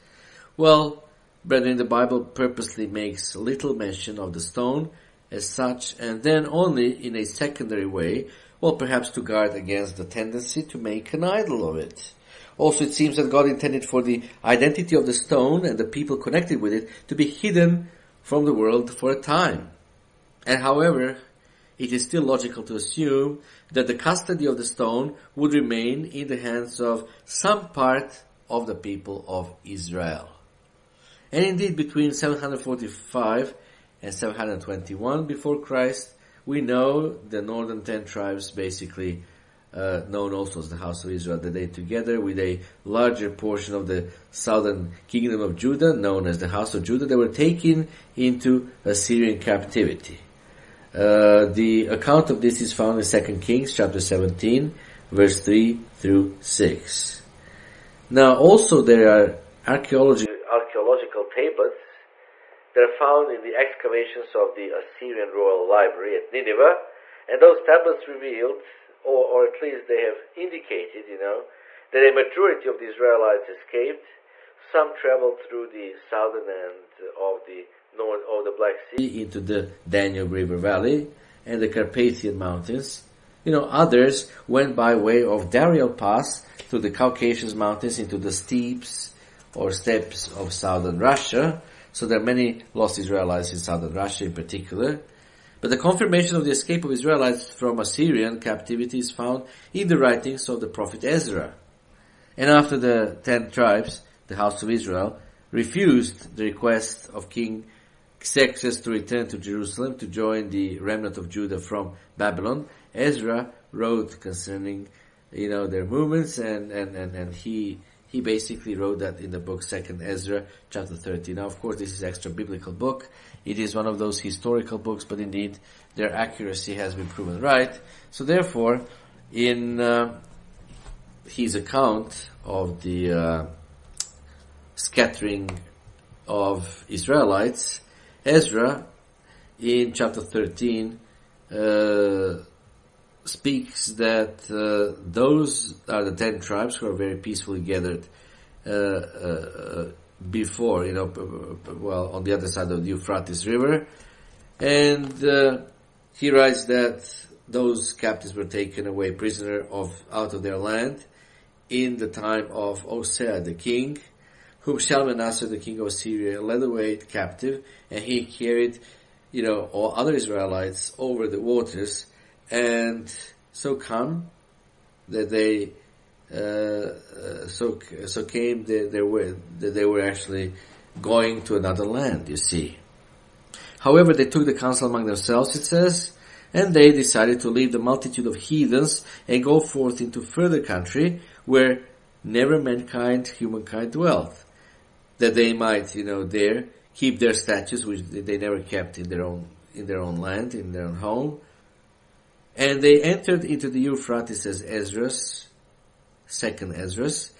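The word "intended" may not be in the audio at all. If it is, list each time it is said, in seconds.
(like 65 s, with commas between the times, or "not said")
13 s.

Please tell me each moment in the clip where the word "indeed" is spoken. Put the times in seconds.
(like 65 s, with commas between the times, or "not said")
31 s, 125 s.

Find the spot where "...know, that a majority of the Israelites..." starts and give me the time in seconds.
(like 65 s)
71 s.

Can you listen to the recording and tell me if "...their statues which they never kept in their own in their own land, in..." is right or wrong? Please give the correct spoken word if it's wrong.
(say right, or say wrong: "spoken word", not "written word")
right.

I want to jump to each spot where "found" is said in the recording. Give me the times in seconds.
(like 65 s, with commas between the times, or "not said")
52 s, 62 s, 99 s.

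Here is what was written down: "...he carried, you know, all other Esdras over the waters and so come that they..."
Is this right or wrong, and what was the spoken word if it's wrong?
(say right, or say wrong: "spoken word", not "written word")
wrong: "Israelites", not "Esdras".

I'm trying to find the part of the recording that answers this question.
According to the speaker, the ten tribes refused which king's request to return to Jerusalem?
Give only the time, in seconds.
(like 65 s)
107 s.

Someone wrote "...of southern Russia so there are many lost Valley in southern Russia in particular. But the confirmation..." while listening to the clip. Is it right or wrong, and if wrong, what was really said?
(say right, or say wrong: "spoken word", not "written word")
wrong: "Israelites", not "Valley".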